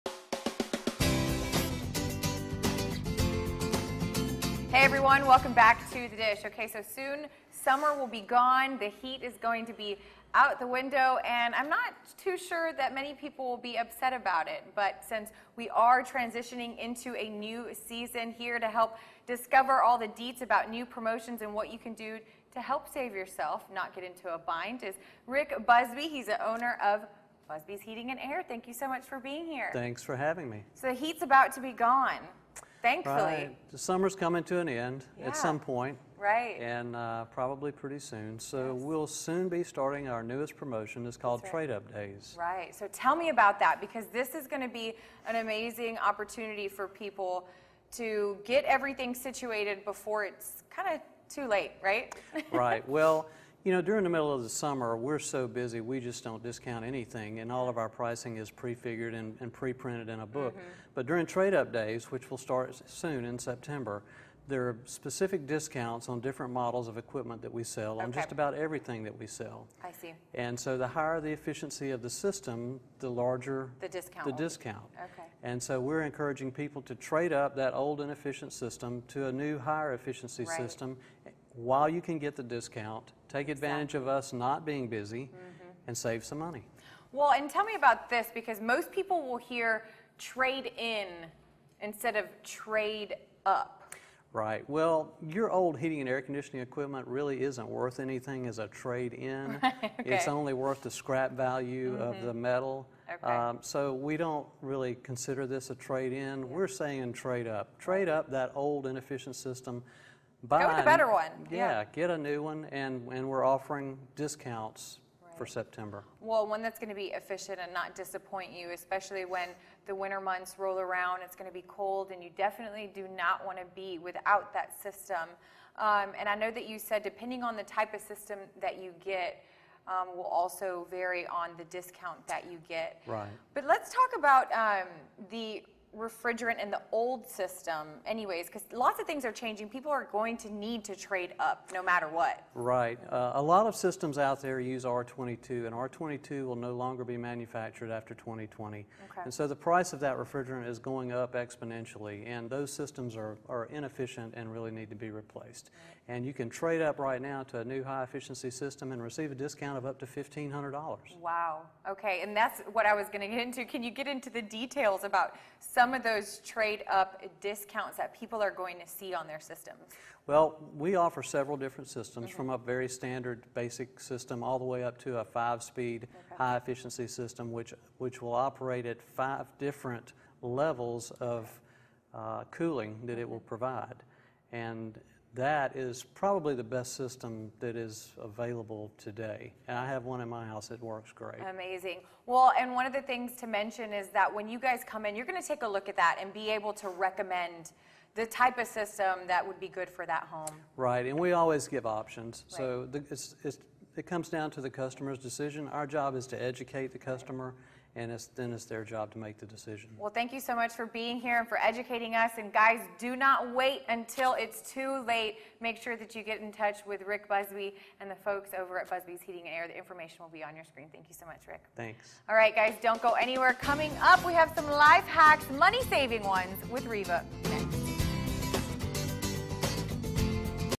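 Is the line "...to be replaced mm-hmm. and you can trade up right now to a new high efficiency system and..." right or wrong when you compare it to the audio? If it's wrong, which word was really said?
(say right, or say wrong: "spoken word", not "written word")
right.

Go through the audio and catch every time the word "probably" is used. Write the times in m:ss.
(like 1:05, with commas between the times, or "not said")
0:37, 3:06.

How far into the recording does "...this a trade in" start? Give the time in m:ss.
1:45.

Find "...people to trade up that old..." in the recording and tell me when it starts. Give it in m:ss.
1:16.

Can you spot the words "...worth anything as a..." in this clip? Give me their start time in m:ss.
1:37.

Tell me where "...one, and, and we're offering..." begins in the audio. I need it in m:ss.
1:52.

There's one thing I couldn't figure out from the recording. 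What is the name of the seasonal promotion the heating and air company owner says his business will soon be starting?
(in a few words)
Trade Up Days.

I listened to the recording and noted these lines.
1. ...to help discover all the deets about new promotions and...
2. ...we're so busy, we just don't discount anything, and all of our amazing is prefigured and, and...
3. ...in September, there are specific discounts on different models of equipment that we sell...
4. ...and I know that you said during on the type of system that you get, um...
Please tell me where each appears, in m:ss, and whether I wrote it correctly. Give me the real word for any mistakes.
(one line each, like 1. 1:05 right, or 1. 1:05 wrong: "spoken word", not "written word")
1. 0:18 right
2. 0:54 wrong: "pricing", not "amazing"
3. 1:03 right
4. 2:06 wrong: "depending", not "during".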